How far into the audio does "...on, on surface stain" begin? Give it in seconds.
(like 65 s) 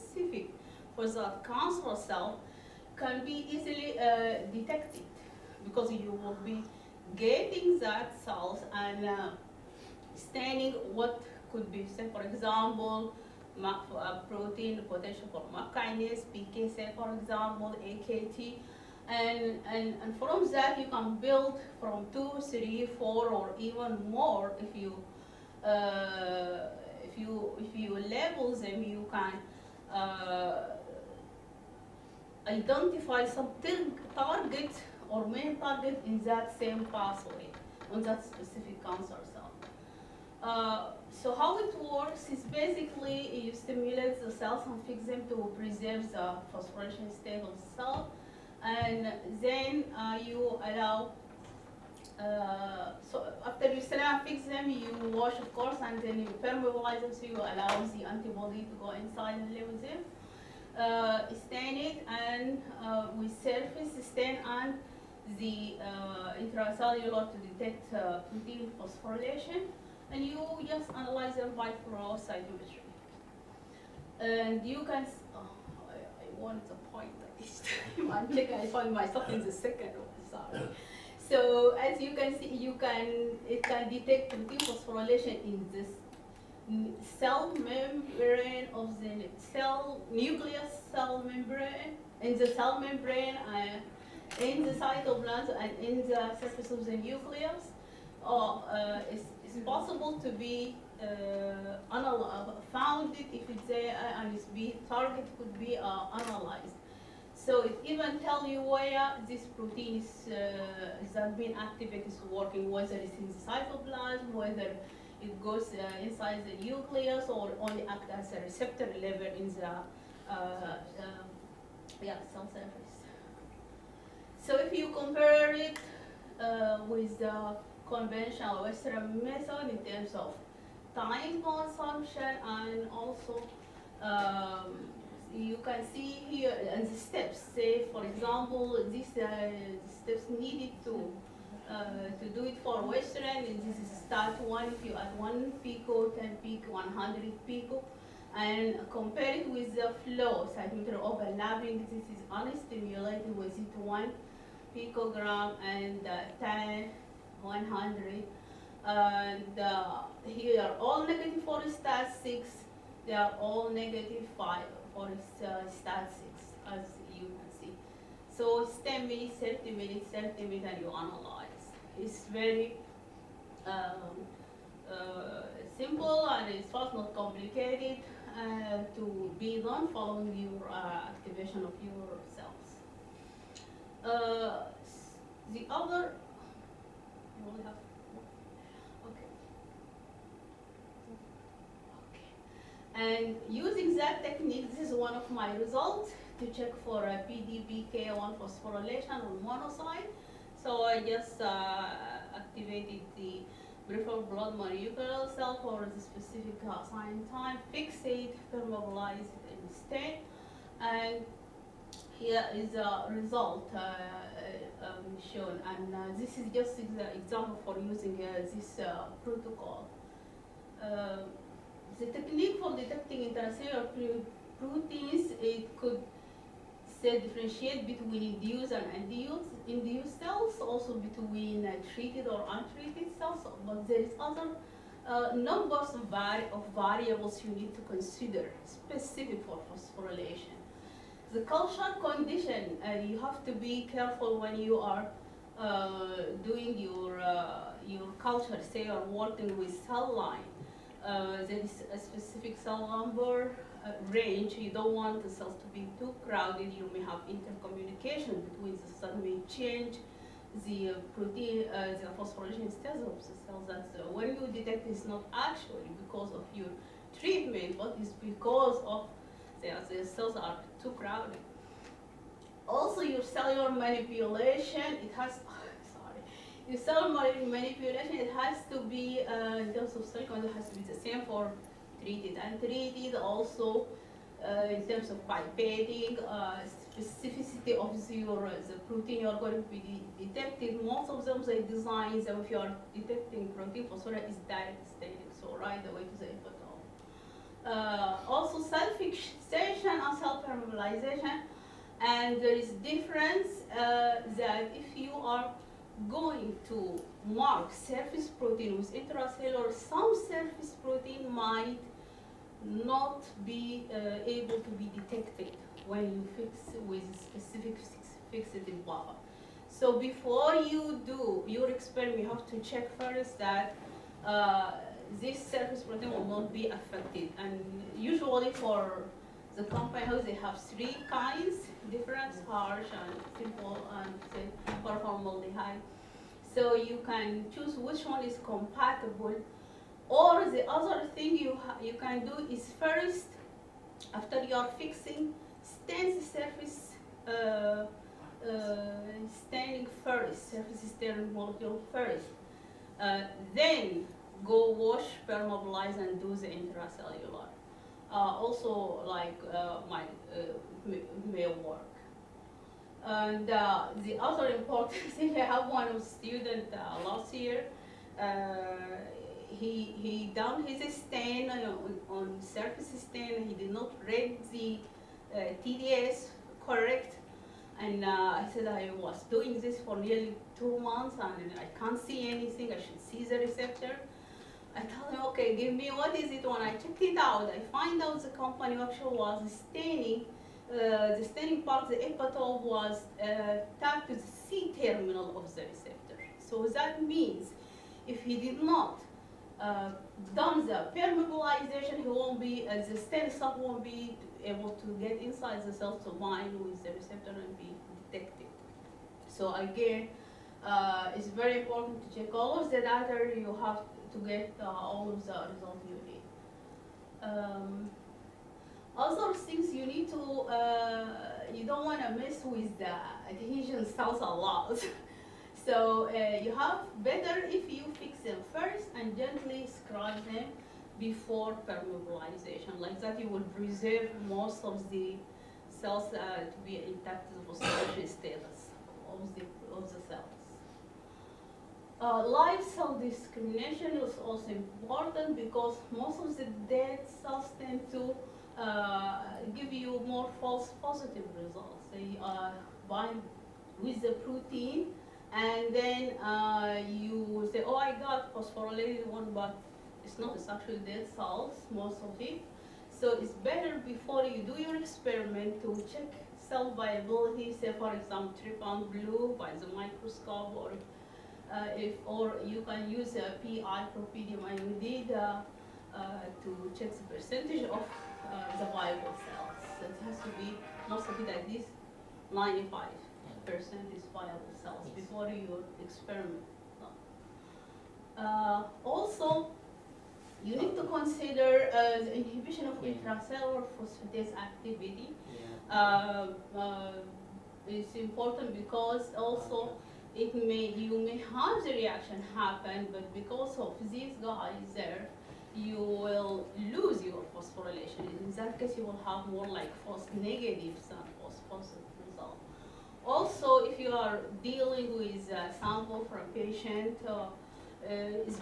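371 s.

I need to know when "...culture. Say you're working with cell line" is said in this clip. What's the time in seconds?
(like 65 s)
248 s.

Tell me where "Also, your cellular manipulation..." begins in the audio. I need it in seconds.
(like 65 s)
272 s.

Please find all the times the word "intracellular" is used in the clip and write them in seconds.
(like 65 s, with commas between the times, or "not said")
66 s, 223 s, 308 s, 356 s, 492 s.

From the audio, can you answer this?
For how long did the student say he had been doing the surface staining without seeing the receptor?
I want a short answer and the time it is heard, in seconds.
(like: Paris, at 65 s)
nearly two months, at 379 s.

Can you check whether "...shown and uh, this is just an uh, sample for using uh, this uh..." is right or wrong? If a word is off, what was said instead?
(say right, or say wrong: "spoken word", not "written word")
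wrong: "example", not "sample".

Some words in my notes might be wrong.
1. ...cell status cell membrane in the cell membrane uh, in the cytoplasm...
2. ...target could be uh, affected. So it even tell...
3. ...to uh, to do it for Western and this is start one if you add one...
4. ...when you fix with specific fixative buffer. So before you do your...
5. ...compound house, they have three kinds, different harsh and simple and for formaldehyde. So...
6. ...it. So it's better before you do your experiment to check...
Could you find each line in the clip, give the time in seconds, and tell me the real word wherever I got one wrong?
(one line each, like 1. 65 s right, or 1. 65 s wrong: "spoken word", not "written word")
1. 89 s wrong: "nucleus", not "status"
2. 104 s wrong: "analyzed", not "affected"
3. 140 s right
4. 315 s right
5. 329 s right
6. 462 s right.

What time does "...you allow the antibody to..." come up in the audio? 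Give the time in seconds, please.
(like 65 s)
57 s.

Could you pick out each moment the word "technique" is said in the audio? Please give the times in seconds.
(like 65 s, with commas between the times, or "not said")
194 s, 222 s.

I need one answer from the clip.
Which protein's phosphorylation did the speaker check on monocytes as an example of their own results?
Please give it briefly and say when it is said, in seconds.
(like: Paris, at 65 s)
PDPK1, at 197 s.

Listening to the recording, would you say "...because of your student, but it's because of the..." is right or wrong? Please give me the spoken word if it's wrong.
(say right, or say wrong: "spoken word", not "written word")
wrong: "treatment", not "student".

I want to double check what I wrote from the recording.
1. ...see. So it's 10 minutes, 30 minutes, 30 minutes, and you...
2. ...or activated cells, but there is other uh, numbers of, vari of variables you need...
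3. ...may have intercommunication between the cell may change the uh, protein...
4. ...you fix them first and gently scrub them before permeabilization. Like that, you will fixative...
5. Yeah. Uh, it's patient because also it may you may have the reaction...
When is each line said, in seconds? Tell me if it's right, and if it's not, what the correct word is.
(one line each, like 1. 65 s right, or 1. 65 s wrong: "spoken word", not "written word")
1. 167 s right
2. 232 s wrong: "untreated", not "activated"
3. 256 s right
4. 427 s wrong: "preserve", not "fixative"
5. 495 s wrong: "important", not "patient".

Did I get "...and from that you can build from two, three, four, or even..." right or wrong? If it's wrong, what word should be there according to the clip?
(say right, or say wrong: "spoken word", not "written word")
right.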